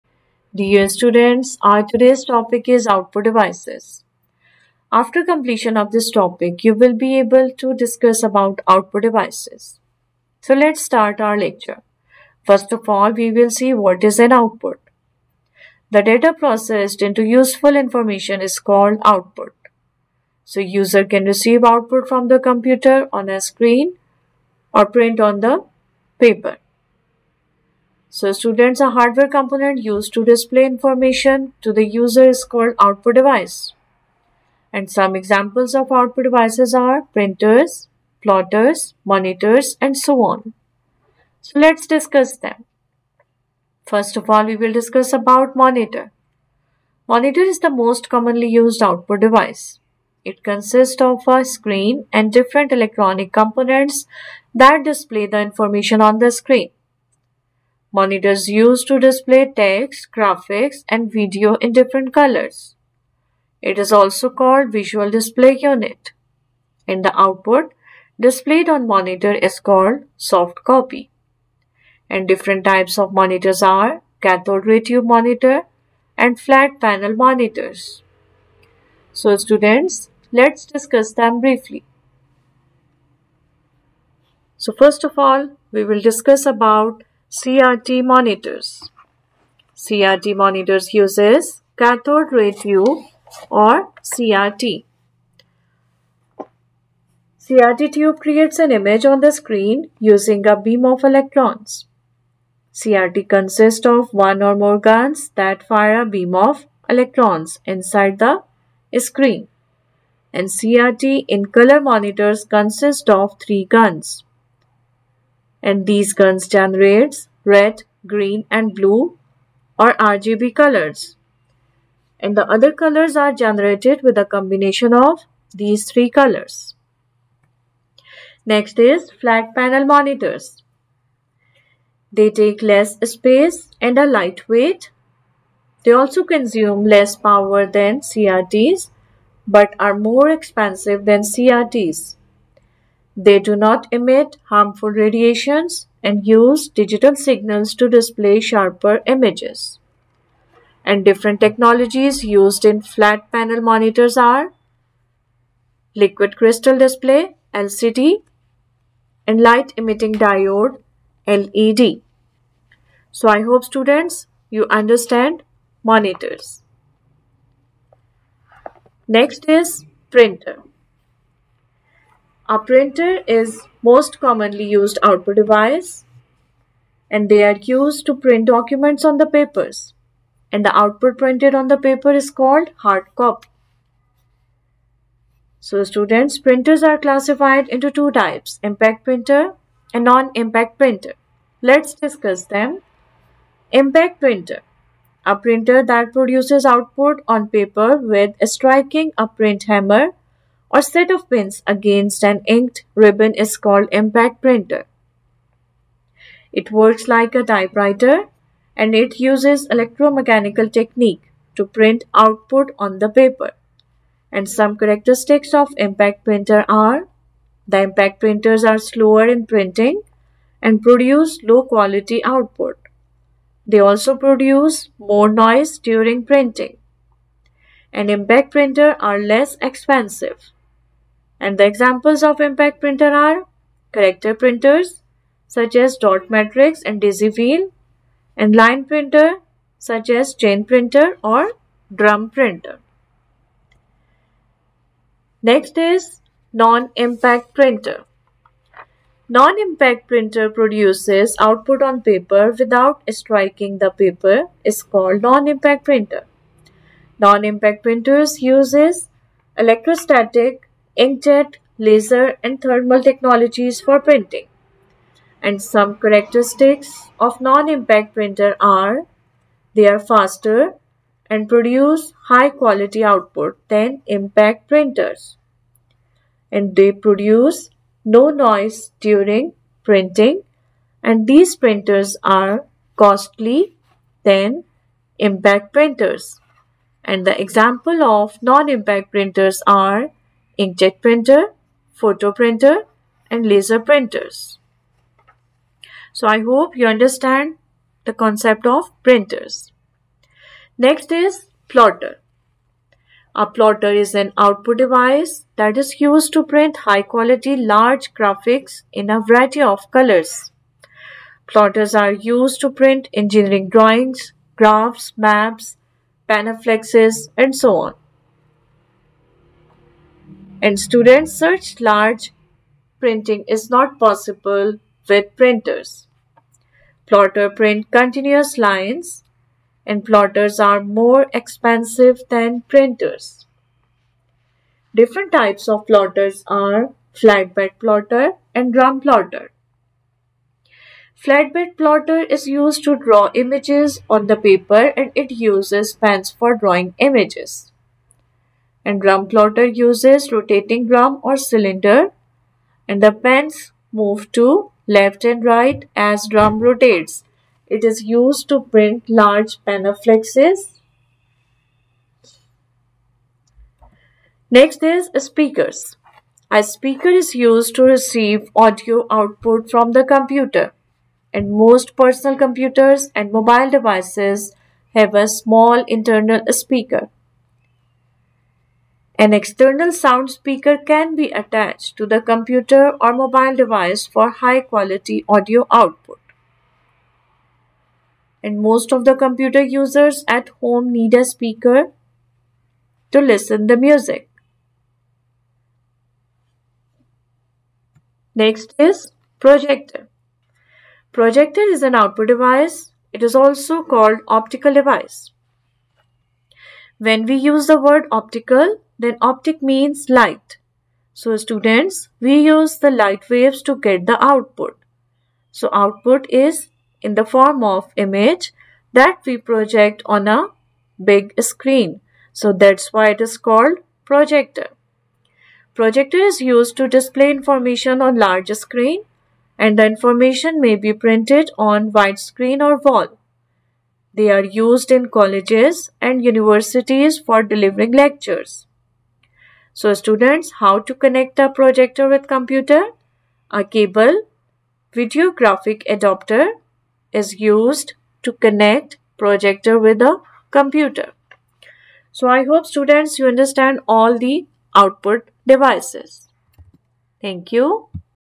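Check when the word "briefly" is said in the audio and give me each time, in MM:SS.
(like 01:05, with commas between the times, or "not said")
01:21.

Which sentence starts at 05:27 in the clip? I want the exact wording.
Plotter print continuous lines and plotters are more expensive than printers.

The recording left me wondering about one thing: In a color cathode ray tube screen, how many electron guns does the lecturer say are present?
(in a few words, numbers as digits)
3.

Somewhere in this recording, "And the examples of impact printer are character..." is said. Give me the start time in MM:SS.
03:51.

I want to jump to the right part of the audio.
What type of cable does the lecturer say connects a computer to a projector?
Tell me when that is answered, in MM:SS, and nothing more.
07:24.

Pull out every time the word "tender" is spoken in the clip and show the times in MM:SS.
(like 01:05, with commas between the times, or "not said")
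not said.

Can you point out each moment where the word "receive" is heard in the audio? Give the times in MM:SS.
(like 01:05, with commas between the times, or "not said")
00:21, 06:07.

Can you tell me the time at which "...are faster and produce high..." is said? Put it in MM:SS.
04:29.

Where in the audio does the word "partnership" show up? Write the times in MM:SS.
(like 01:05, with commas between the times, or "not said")
not said.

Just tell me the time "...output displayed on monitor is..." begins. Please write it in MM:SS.
01:07.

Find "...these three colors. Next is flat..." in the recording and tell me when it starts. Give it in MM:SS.
02:05.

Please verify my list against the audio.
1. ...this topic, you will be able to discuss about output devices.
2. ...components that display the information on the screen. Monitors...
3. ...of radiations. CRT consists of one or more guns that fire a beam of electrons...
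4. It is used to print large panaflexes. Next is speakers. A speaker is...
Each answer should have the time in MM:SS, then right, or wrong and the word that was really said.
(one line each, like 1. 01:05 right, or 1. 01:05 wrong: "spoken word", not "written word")
1. 00:05 right
2. 00:53 right
3. 01:40 wrong: "electrons", not "radiations"
4. 05:57 right.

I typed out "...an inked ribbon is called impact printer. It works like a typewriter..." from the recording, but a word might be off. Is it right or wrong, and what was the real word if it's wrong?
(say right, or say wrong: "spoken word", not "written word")
right.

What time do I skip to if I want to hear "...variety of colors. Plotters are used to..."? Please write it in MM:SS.
05:09.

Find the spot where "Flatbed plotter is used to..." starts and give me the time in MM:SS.
05:41.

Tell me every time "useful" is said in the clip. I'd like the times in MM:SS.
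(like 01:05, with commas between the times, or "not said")
00:17.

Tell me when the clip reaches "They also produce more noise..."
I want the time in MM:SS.
03:43.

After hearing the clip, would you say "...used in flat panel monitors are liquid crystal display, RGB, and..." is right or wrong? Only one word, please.
wrong.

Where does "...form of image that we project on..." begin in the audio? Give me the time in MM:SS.
06:57.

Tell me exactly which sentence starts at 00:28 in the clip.
So students, a hardware component used to display information to the user is called output device.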